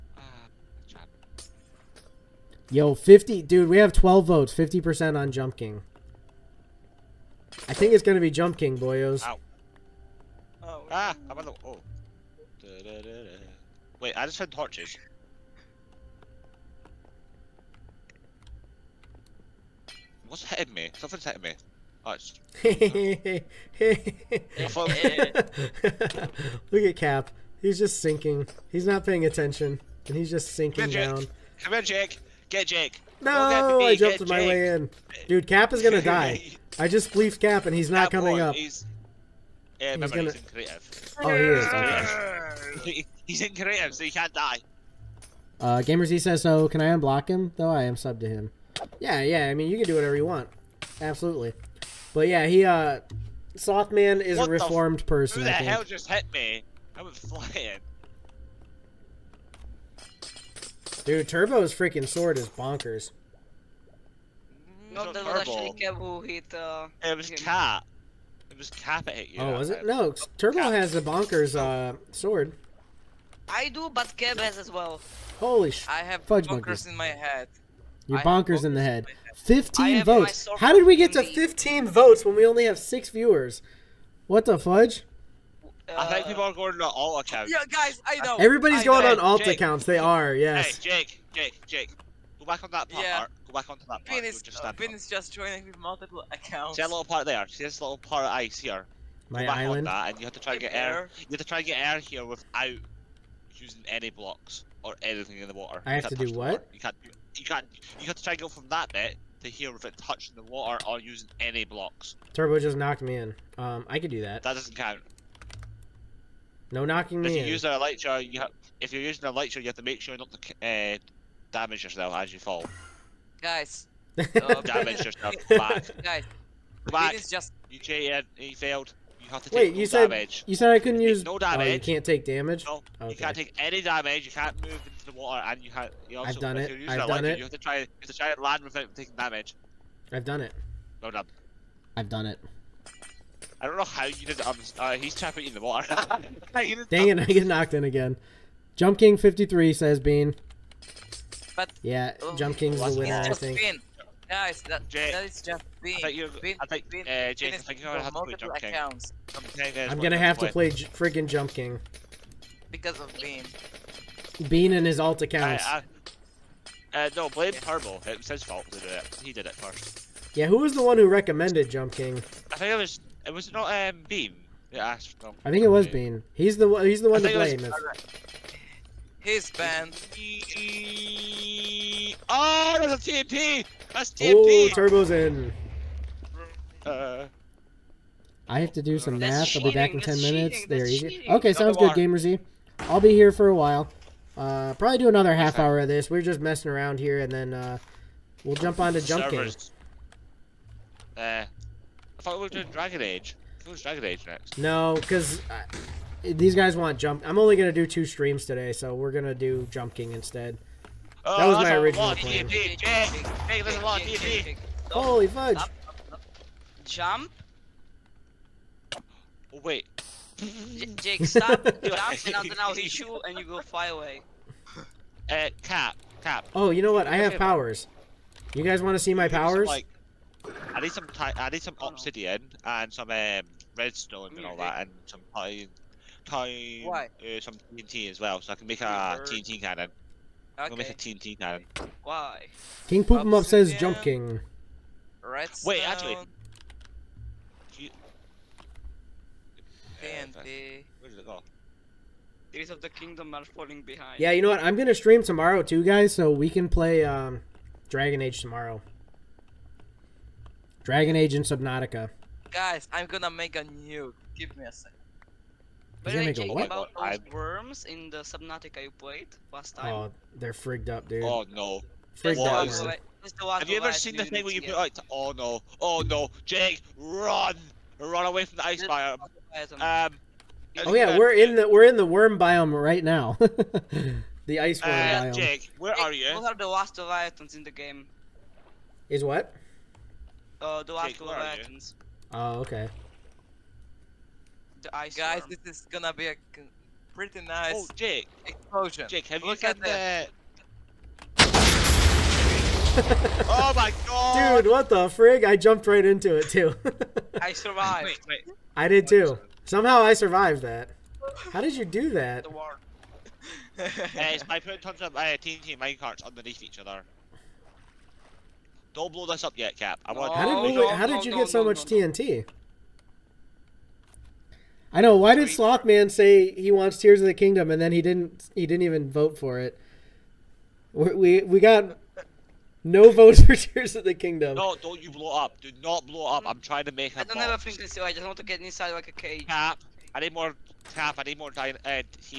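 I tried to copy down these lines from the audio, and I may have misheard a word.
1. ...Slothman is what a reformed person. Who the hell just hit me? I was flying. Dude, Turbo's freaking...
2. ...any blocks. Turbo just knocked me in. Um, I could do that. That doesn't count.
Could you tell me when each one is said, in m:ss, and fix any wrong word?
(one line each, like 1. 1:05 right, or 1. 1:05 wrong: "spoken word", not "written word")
1. 0:53 right
2. 1:51 right.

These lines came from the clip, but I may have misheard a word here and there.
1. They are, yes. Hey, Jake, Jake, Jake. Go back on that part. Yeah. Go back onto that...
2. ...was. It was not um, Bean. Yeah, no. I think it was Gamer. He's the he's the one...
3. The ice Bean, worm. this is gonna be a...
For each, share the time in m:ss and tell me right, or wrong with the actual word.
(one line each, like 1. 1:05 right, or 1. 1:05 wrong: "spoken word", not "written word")
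1. 1:29 right
2. 2:52 wrong: "Bean", not "Gamer"
3. 4:54 wrong: "Guys", not "Bean".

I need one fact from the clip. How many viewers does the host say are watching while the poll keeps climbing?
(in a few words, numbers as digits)
6.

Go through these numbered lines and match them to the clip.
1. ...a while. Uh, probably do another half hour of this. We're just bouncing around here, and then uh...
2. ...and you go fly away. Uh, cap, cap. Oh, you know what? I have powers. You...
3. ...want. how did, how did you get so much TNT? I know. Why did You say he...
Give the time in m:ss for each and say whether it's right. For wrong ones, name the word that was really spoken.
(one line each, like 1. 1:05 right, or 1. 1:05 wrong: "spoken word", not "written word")
1. 3:13 wrong: "messing", not "bouncing"
2. 3:43 right
3. 5:20 wrong: "Slothman", not "You".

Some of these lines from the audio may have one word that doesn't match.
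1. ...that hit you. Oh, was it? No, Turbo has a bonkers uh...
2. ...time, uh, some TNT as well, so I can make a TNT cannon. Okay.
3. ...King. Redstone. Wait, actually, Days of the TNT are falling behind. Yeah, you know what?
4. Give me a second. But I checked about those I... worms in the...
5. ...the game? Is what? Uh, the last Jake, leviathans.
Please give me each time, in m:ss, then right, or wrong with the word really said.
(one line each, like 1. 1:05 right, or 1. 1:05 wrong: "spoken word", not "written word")
1. 1:09 right
2. 3:56 right
3. 4:04 wrong: "Kingdom", not "TNT"
4. 4:24 right
5. 4:47 right.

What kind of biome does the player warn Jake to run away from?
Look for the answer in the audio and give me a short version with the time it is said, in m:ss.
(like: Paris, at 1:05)
ice biome, at 4:38.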